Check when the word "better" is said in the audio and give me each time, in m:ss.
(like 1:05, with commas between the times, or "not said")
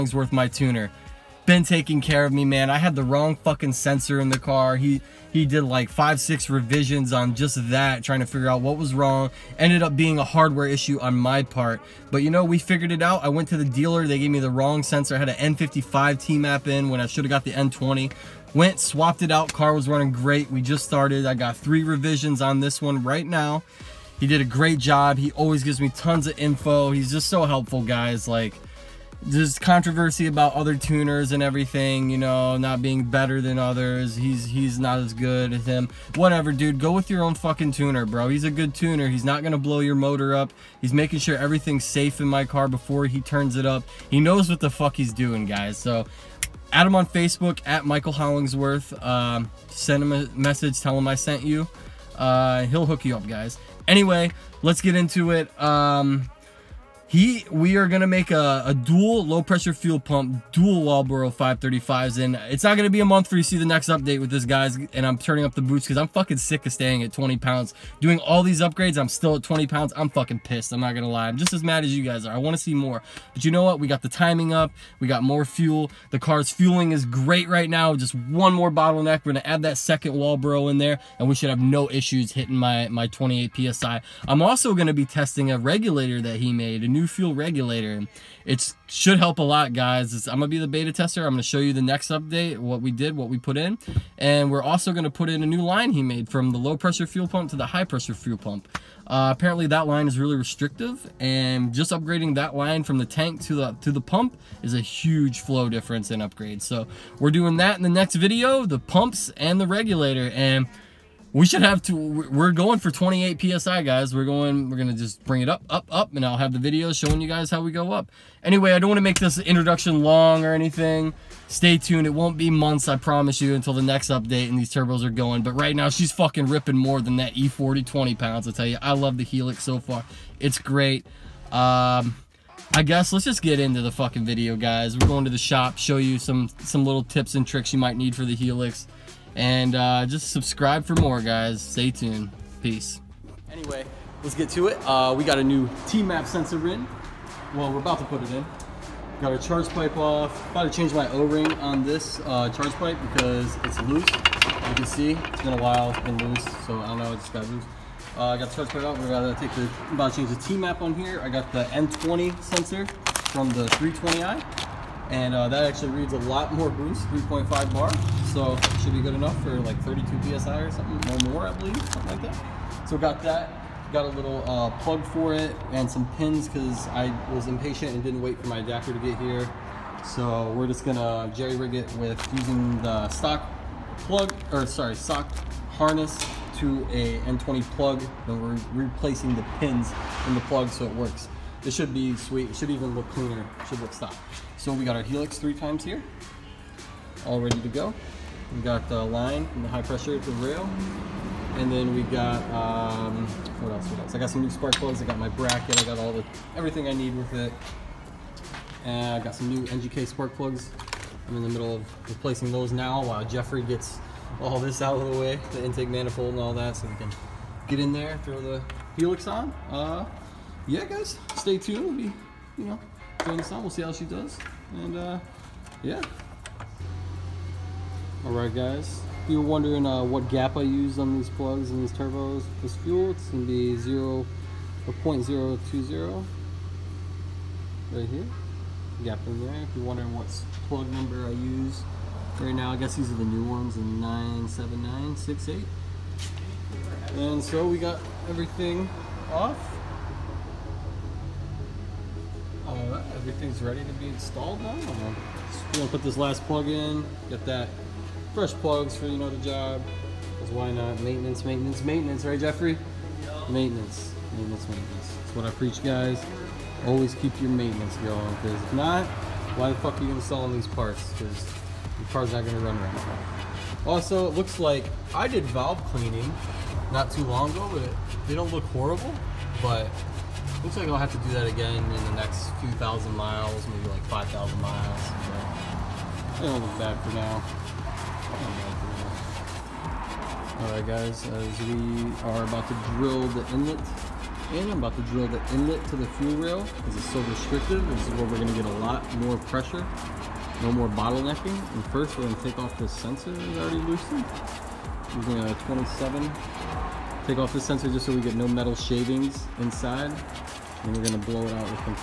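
0:33.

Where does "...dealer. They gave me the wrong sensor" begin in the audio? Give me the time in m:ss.
0:13.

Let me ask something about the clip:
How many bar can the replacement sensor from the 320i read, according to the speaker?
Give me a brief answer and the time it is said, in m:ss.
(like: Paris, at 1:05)
3.5 bar, at 2:47.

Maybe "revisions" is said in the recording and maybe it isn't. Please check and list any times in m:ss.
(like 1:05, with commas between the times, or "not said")
0:06, 0:21.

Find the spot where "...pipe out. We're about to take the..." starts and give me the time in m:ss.
2:38.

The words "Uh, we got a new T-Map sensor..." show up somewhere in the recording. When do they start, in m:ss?
2:24.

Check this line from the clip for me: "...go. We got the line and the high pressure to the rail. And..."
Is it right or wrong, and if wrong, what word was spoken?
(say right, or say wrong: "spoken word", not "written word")
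right.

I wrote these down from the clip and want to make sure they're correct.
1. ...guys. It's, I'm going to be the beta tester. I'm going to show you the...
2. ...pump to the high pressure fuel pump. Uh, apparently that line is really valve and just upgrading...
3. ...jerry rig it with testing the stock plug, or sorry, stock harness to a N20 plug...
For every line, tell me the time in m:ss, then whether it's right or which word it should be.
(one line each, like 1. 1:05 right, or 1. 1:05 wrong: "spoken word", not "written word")
1. 1:29 right
2. 1:37 wrong: "restrictive", not "valve"
3. 3:01 wrong: "using", not "testing".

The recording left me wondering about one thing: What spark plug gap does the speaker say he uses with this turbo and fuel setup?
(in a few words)
0.020.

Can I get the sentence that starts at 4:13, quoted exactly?
everything's ready to be installed now.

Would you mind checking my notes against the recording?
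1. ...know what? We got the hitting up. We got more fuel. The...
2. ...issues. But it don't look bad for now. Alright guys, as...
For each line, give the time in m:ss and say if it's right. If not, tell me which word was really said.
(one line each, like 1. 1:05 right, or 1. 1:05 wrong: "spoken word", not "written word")
1. 1:13 wrong: "timing", not "hitting"
2. 4:44 wrong: "miles", not "issues".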